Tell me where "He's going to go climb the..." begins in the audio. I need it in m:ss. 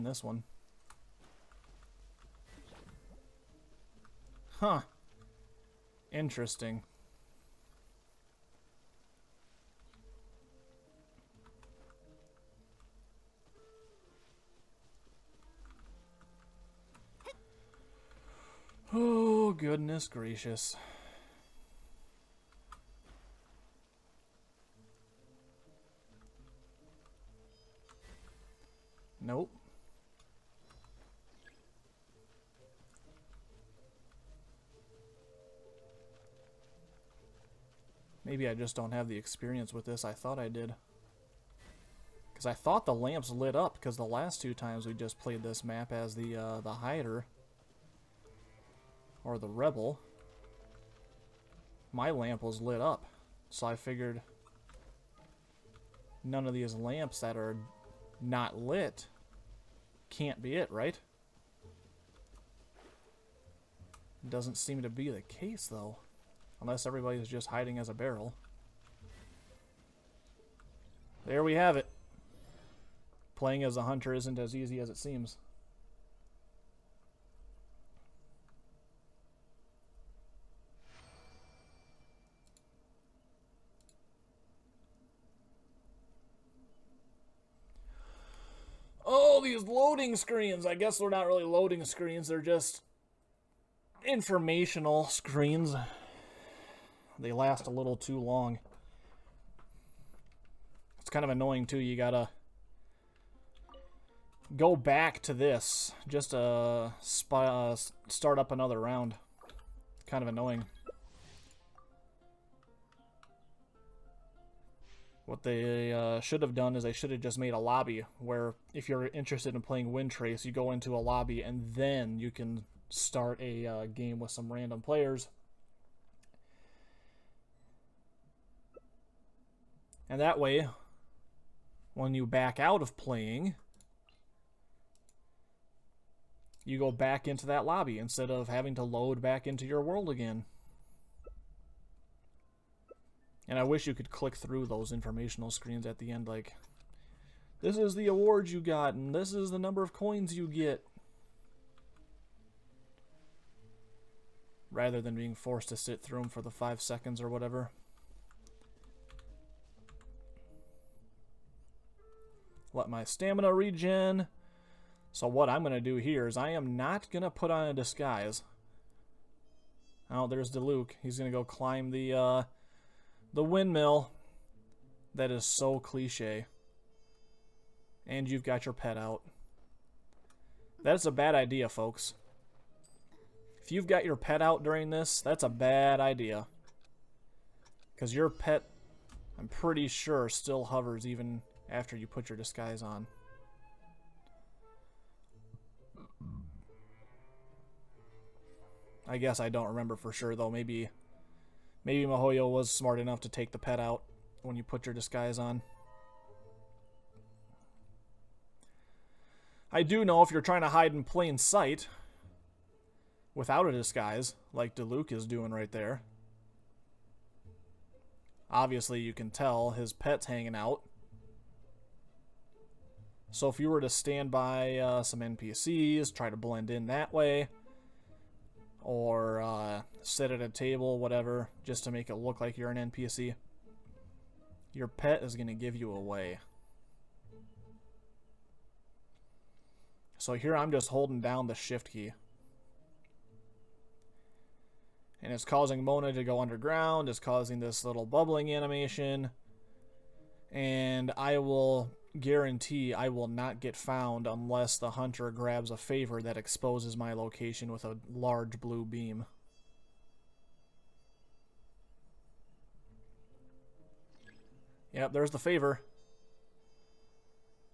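2:51.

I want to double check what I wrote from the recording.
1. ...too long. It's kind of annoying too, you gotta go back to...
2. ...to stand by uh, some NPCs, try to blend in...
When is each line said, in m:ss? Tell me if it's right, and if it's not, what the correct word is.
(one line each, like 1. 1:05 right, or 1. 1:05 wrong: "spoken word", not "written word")
1. 1:37 right
2. 3:43 right.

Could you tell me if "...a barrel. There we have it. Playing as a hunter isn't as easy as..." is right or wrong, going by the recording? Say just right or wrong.
right.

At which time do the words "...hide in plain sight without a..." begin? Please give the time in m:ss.
3:30.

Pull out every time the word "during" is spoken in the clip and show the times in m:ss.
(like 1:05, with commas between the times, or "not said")
3:04.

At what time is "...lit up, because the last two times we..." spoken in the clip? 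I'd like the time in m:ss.
0:43.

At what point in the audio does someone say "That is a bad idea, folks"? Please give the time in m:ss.
3:00.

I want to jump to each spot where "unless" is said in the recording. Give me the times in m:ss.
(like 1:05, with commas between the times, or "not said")
1:06, 4:14.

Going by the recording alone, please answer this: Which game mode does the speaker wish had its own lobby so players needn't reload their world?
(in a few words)
Windtrace.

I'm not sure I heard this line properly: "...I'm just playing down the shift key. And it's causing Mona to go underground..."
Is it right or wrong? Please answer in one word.
wrong.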